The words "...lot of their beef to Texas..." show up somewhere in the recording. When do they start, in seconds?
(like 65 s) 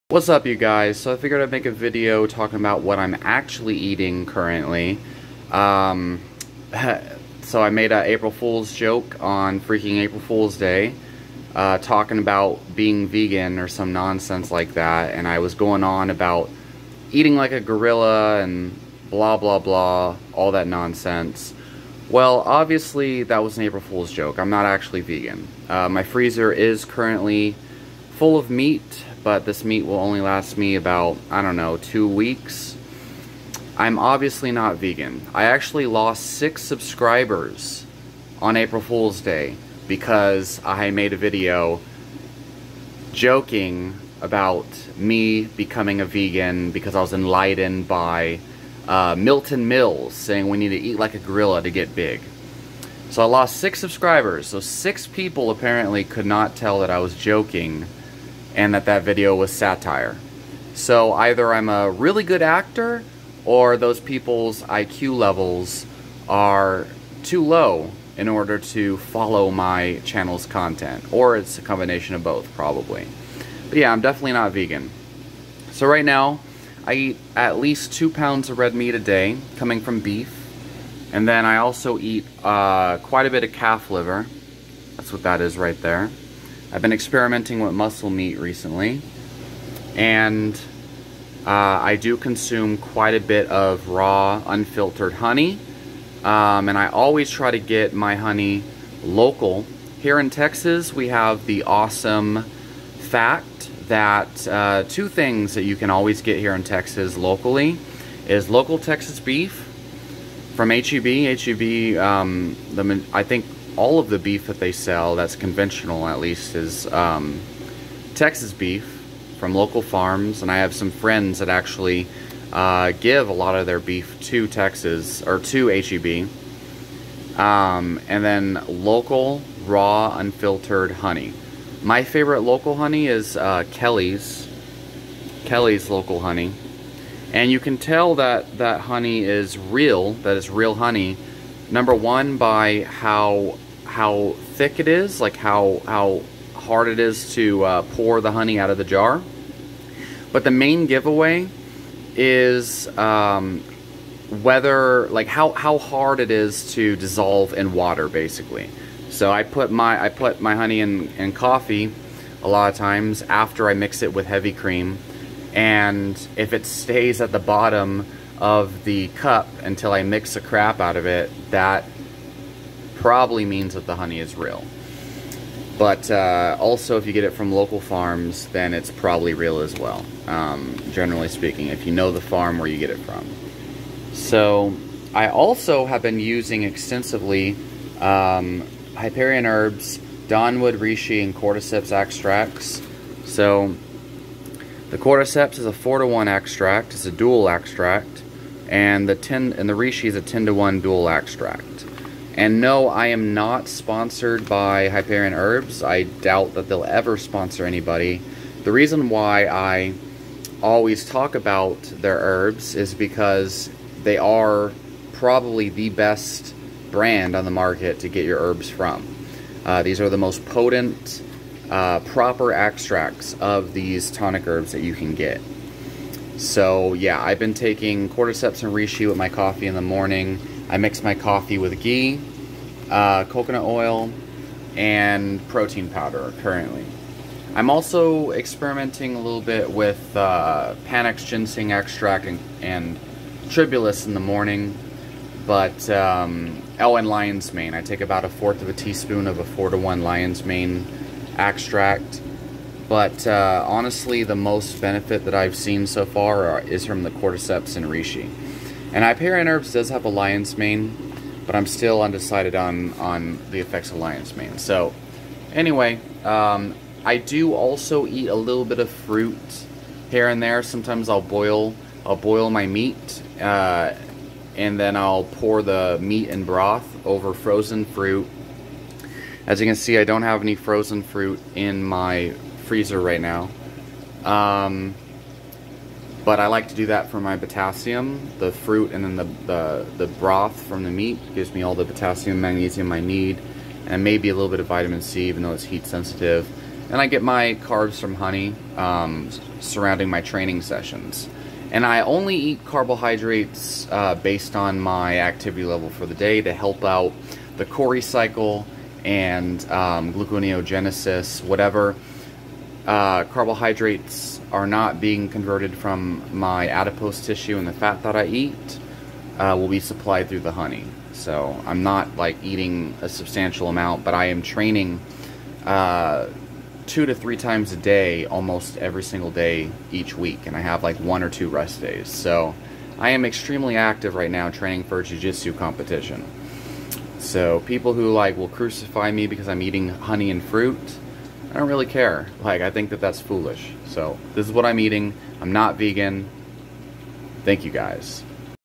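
123 s.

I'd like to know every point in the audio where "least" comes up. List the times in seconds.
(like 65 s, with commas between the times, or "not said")
77 s, 116 s.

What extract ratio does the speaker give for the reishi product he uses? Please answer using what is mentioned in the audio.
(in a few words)
10 to 1.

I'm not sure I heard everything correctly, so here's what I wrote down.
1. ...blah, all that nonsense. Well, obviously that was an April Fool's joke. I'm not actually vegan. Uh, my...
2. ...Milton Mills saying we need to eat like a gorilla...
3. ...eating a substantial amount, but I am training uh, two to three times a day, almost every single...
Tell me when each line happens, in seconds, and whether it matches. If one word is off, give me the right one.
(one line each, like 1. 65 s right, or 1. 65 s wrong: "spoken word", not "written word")
1. 19 s right
2. 49 s right
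3. 322 s right.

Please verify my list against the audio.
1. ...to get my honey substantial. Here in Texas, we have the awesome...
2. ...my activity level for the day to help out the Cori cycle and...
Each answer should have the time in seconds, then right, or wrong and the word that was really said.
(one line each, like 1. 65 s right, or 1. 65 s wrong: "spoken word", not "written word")
1. 97 s wrong: "local", not "substantial"
2. 304 s right.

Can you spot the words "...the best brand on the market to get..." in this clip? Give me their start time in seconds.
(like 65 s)
215 s.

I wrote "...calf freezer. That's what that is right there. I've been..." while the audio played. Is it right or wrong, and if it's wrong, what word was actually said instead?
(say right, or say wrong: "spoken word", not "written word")
wrong: "liver", not "freezer".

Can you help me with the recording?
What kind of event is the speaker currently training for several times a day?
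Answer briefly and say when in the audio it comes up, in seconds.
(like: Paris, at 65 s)
Jiu-jitsu competition, at 335 s.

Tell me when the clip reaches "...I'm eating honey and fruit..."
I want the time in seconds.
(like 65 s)
339 s.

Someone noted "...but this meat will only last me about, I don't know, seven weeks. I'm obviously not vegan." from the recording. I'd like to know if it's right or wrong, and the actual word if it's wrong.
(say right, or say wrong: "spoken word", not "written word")
wrong: "two", not "seven".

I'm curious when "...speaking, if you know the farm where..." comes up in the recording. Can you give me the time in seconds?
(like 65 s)
181 s.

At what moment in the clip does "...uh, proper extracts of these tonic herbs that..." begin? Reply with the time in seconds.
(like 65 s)
221 s.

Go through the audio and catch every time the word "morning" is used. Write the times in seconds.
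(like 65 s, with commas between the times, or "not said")
229 s, 244 s.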